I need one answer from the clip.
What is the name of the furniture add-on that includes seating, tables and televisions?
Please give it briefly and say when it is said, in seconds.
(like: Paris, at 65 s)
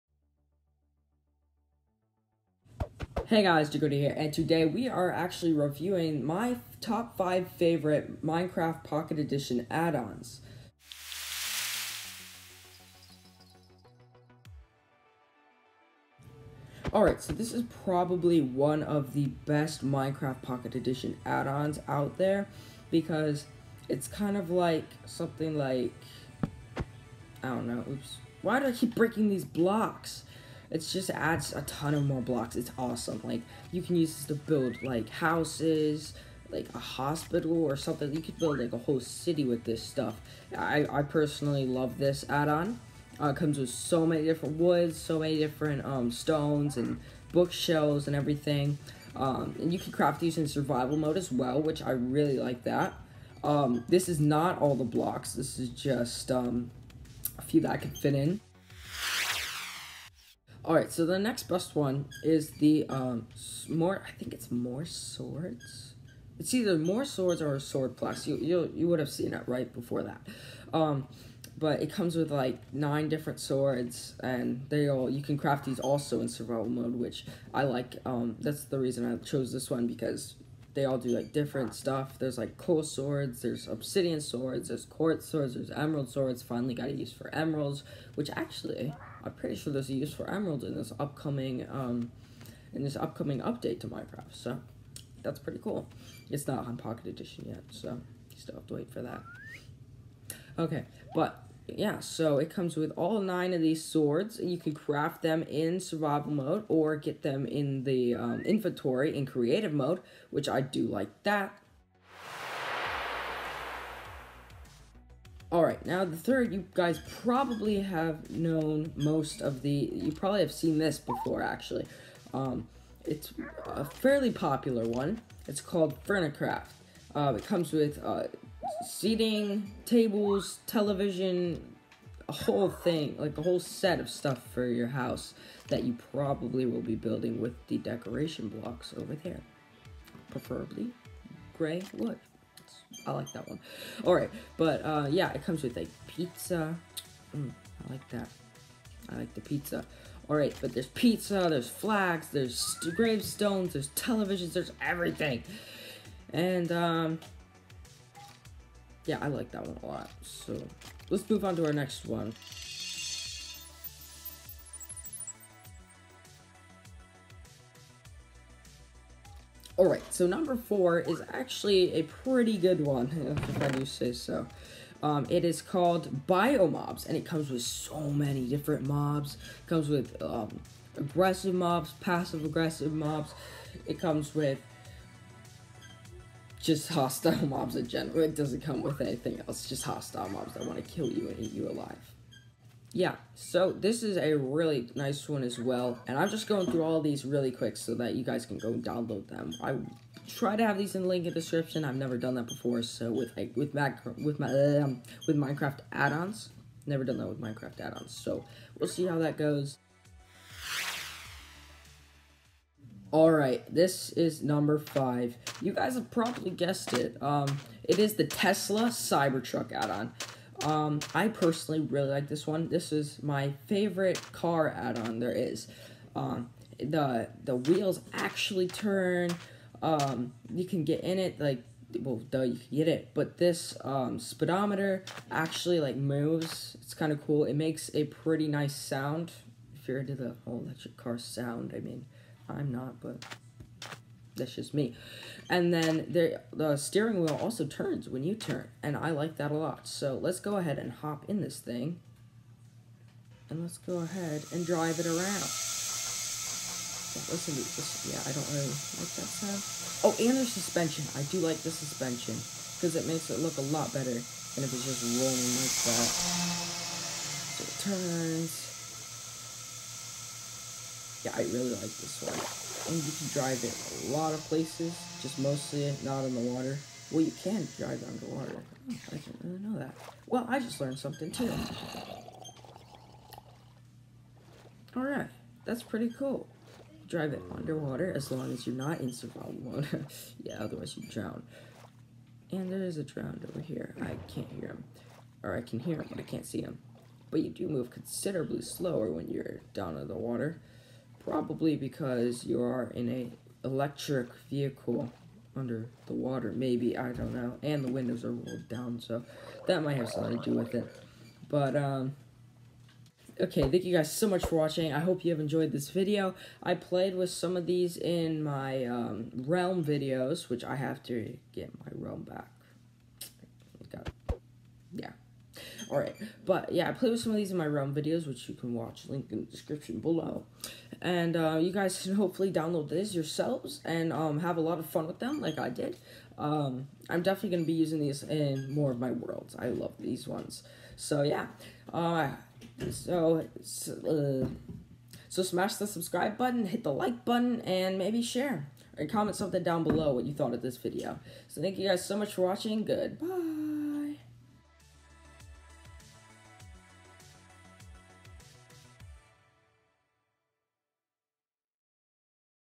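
Furnicraft, at 126 s.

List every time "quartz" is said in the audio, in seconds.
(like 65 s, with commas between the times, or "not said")
84 s.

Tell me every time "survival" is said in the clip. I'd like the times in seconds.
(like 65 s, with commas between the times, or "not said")
50 s, 76 s, 105 s, 289 s.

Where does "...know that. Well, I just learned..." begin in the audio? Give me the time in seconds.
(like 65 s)
279 s.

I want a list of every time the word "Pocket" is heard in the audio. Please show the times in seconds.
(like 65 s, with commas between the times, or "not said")
8 s, 20 s, 96 s.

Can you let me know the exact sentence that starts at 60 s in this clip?
All right, so the next best one is the um, more.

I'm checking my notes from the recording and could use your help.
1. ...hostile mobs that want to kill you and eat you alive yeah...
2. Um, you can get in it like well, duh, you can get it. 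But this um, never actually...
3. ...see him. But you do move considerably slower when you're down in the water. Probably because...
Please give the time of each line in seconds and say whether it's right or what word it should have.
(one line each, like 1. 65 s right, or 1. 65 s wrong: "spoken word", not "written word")
1. 189 s right
2. 229 s wrong: "speedometer", not "never"
3. 296 s right.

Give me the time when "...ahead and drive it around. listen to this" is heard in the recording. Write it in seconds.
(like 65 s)
253 s.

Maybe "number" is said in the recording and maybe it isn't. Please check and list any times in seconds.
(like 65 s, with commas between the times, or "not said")
170 s, 214 s.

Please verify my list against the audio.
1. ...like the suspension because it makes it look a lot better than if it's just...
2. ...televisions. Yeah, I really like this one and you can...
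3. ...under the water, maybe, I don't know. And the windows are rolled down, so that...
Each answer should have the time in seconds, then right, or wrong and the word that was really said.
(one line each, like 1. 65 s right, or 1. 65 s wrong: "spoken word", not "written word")
1. 261 s right
2. 267 s wrong: "turns", not "televisions"
3. 305 s right.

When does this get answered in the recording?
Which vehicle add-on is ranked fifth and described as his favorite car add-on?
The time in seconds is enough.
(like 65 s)
218 s.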